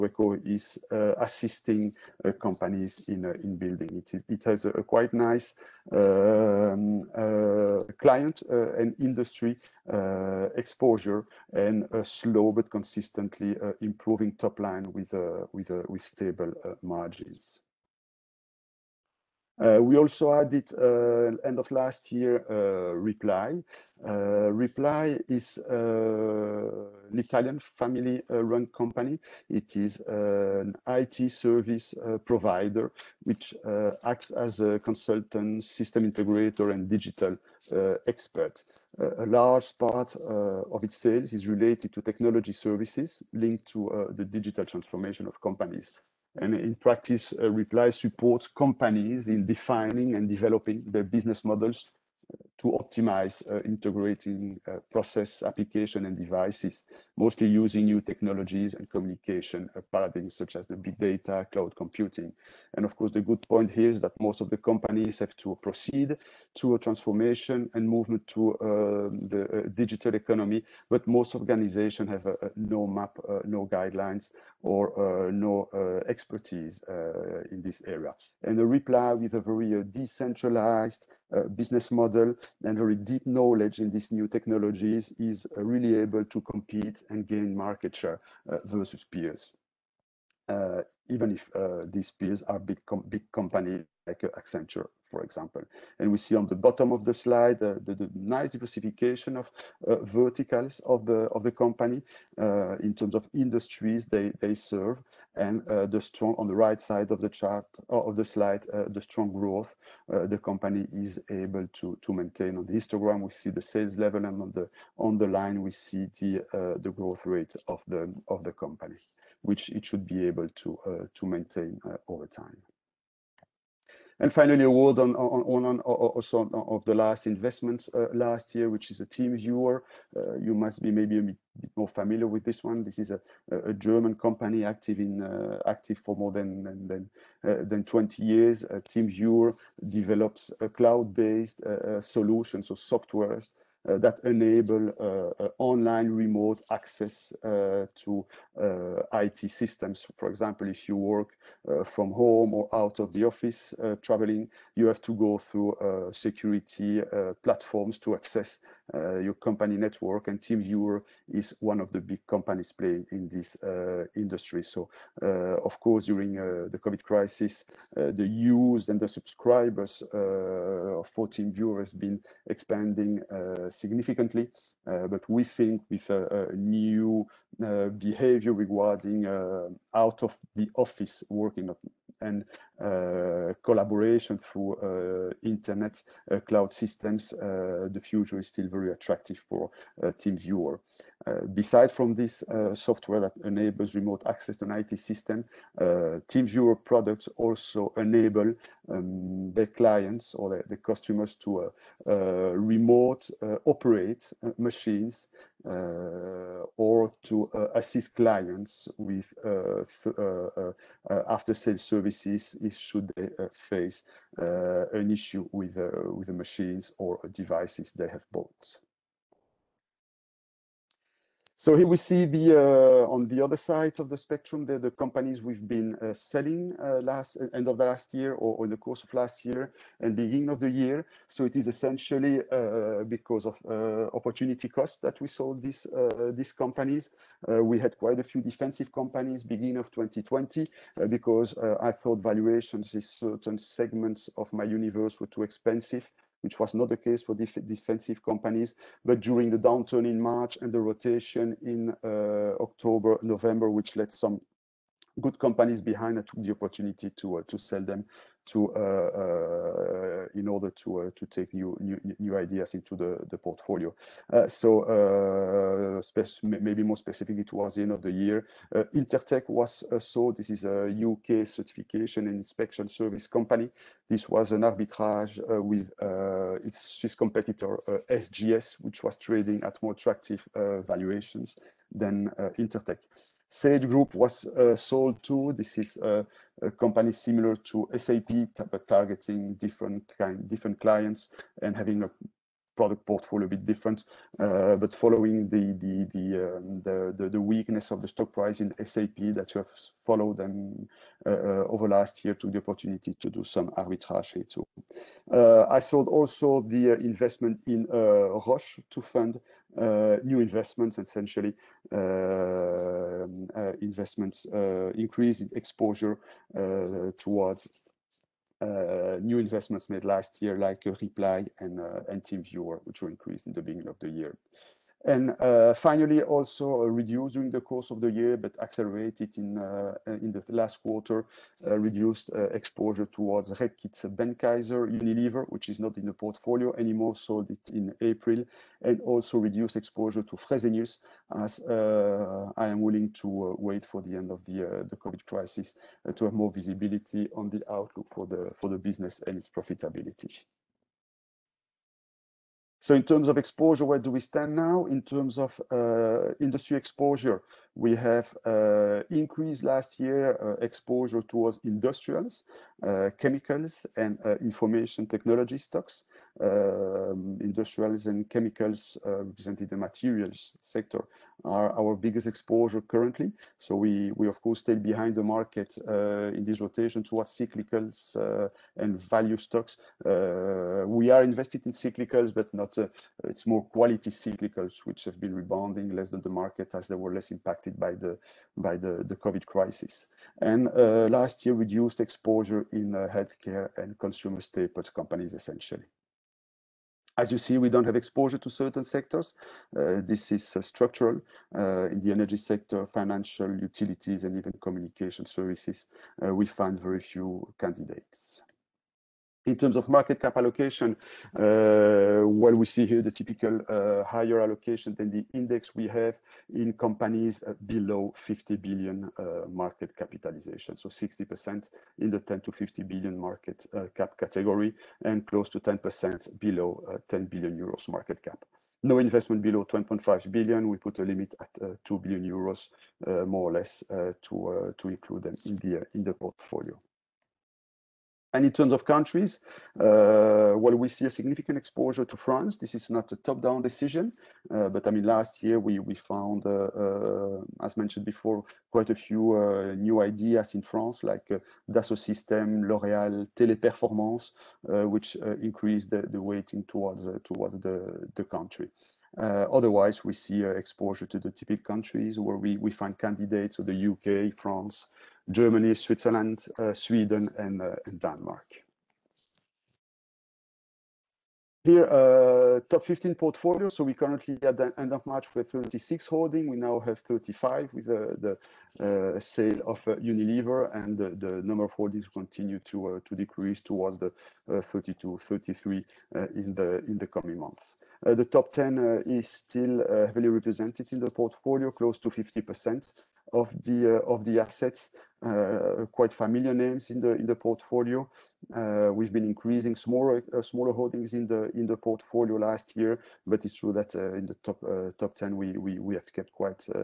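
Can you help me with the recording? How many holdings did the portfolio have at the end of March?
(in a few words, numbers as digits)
36.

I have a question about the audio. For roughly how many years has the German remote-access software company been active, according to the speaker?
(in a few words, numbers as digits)
20 years.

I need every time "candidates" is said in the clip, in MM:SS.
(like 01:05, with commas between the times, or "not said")
06:47, 07:42.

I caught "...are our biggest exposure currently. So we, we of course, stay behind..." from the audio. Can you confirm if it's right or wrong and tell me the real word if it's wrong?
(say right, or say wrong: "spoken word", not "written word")
right.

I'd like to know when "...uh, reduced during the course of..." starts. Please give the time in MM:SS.
05:26.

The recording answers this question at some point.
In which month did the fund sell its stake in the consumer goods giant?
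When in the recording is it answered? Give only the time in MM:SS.
05:38.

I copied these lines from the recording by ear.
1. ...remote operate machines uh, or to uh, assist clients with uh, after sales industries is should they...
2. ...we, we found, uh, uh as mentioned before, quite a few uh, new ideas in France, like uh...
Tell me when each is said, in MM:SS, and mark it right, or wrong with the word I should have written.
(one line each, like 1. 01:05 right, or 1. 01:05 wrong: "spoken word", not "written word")
1. 03:22 wrong: "services", not "industries"
2. 07:25 right.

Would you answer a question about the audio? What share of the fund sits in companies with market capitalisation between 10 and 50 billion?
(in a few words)
60%.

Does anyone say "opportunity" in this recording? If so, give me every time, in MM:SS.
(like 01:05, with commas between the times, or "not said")
03:54, 04:16, 05:02.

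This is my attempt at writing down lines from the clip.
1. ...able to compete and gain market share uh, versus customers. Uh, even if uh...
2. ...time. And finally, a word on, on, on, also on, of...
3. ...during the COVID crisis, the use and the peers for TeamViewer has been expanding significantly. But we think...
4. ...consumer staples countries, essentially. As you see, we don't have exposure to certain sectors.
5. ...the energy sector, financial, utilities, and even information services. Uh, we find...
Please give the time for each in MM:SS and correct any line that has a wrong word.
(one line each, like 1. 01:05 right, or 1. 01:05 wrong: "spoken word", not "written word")
1. 01:25 wrong: "peers", not "customers"
2. 02:02 right
3. 02:46 wrong: "subscribers", not "peers"
4. 06:33 wrong: "companies", not "countries"
5. 06:42 wrong: "communication", not "information".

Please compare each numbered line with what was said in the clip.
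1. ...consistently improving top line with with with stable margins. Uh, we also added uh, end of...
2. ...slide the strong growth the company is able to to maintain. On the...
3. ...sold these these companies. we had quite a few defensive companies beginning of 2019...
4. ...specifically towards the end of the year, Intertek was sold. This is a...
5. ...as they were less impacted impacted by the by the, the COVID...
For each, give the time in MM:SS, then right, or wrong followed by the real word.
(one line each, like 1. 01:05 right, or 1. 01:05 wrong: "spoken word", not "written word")
1. 00:12 right
2. 01:48 right
3. 03:55 wrong: "2020", not "2019"
4. 04:26 right
5. 06:26 right.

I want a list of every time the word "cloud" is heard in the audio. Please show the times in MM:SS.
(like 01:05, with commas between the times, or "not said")
01:01, 02:20, 03:06.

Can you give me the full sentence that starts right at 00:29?
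It is an IT service provider which acts as a consultant, system integrator, and digital expert.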